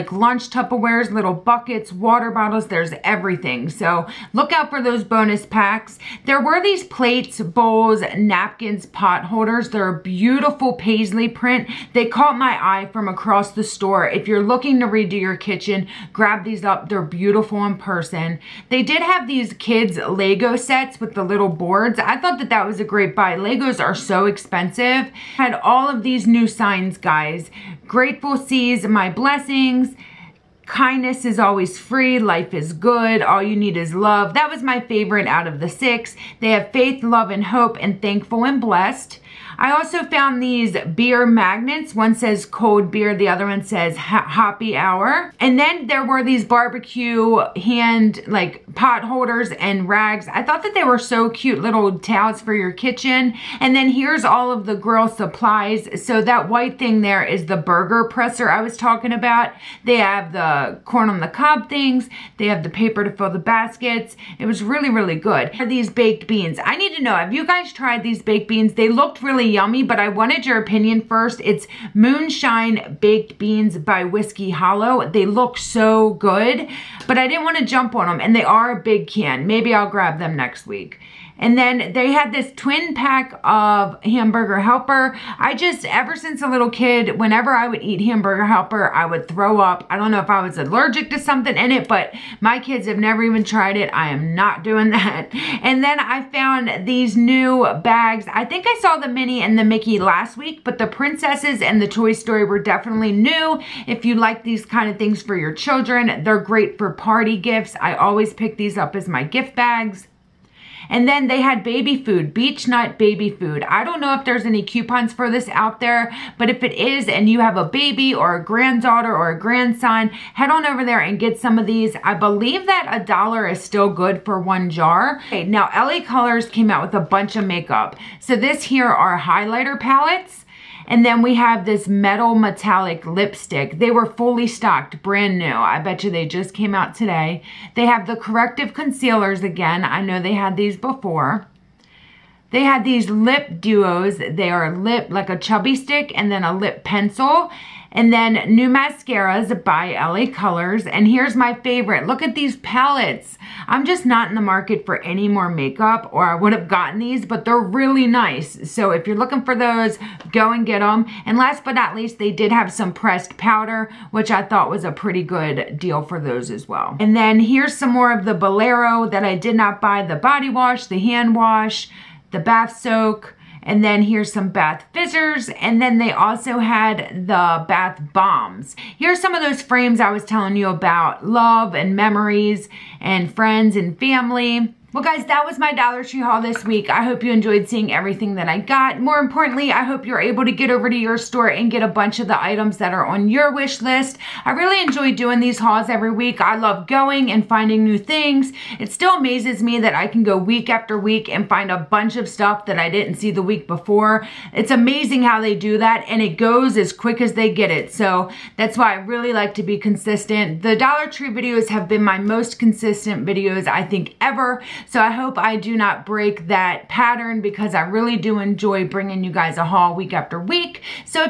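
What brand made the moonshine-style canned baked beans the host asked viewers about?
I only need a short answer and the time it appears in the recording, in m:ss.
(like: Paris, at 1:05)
Whiskey Hollow, at 1:14.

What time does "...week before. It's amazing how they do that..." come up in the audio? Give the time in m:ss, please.
3:23.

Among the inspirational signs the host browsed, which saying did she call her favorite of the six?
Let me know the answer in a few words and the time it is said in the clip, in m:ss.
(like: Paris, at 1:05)
All you need is love, at 0:33.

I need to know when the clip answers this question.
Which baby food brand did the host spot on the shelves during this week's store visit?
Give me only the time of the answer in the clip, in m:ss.
1:52.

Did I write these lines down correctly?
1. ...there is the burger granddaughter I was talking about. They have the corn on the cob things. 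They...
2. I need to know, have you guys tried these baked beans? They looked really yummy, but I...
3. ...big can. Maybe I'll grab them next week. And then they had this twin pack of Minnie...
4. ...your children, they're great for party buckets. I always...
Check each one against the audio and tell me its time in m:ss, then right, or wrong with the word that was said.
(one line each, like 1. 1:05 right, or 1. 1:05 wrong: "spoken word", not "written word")
1. 0:57 wrong: "presser", not "granddaughter"
2. 1:06 right
3. 1:18 wrong: "Hamburger", not "Minnie"
4. 1:45 wrong: "gifts", not "buckets".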